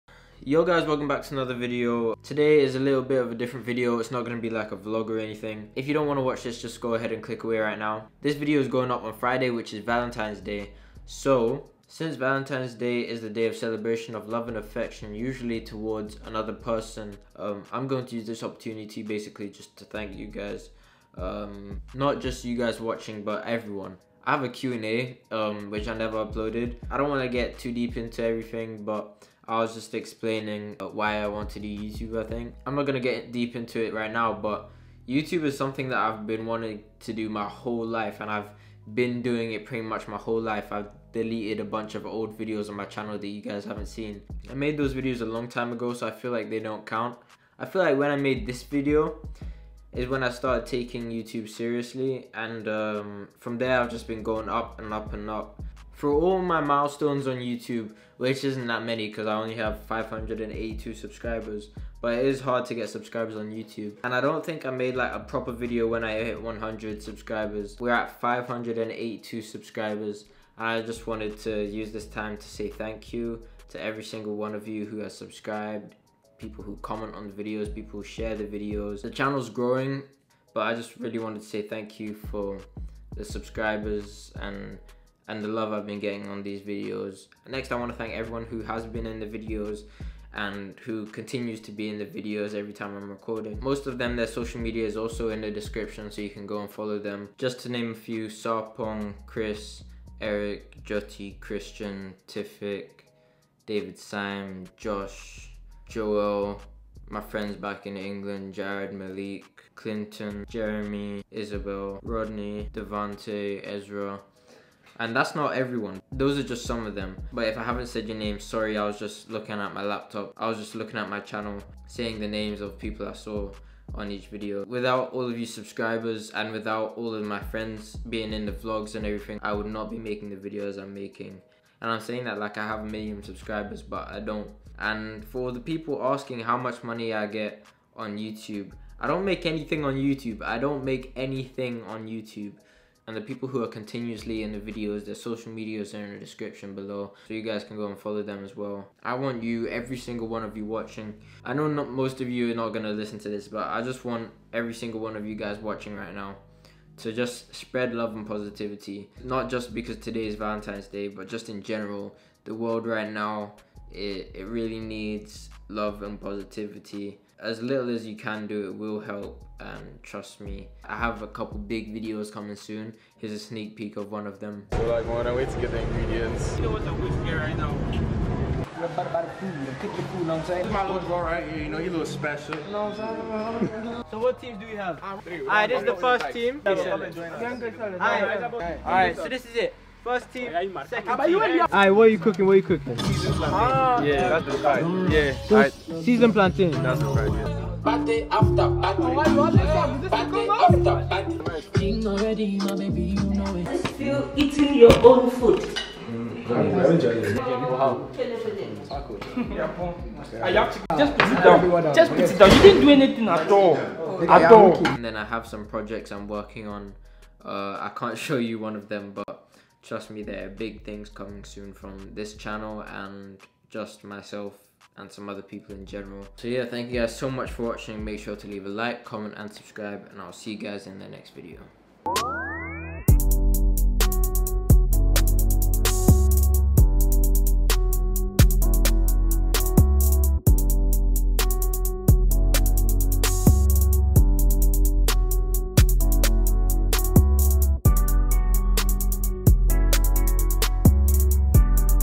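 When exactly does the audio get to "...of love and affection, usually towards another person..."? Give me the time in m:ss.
0:14.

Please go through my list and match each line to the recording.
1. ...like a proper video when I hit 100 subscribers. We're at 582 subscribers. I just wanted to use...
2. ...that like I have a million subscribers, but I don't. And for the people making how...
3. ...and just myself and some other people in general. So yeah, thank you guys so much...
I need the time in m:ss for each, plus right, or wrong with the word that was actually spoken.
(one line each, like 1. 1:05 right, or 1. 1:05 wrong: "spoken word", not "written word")
1. 1:04 right
2. 2:12 wrong: "asking", not "making"
3. 3:42 right.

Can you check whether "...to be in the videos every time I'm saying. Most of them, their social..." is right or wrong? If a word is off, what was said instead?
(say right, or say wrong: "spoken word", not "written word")
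wrong: "recording", not "saying".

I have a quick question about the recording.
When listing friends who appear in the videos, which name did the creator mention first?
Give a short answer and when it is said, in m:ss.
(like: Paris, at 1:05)
Sarpong, at 1:38.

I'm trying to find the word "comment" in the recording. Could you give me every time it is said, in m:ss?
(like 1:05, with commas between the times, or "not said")
1:16, 3:49.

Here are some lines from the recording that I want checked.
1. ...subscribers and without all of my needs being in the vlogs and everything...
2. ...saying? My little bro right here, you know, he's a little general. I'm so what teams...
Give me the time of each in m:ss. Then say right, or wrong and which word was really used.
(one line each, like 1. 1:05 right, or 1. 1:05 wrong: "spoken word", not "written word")
1. 2:05 wrong: "friends", not "needs"
2. 3:00 wrong: "special", not "general".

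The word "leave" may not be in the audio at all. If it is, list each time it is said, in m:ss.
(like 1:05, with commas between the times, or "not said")
3:48.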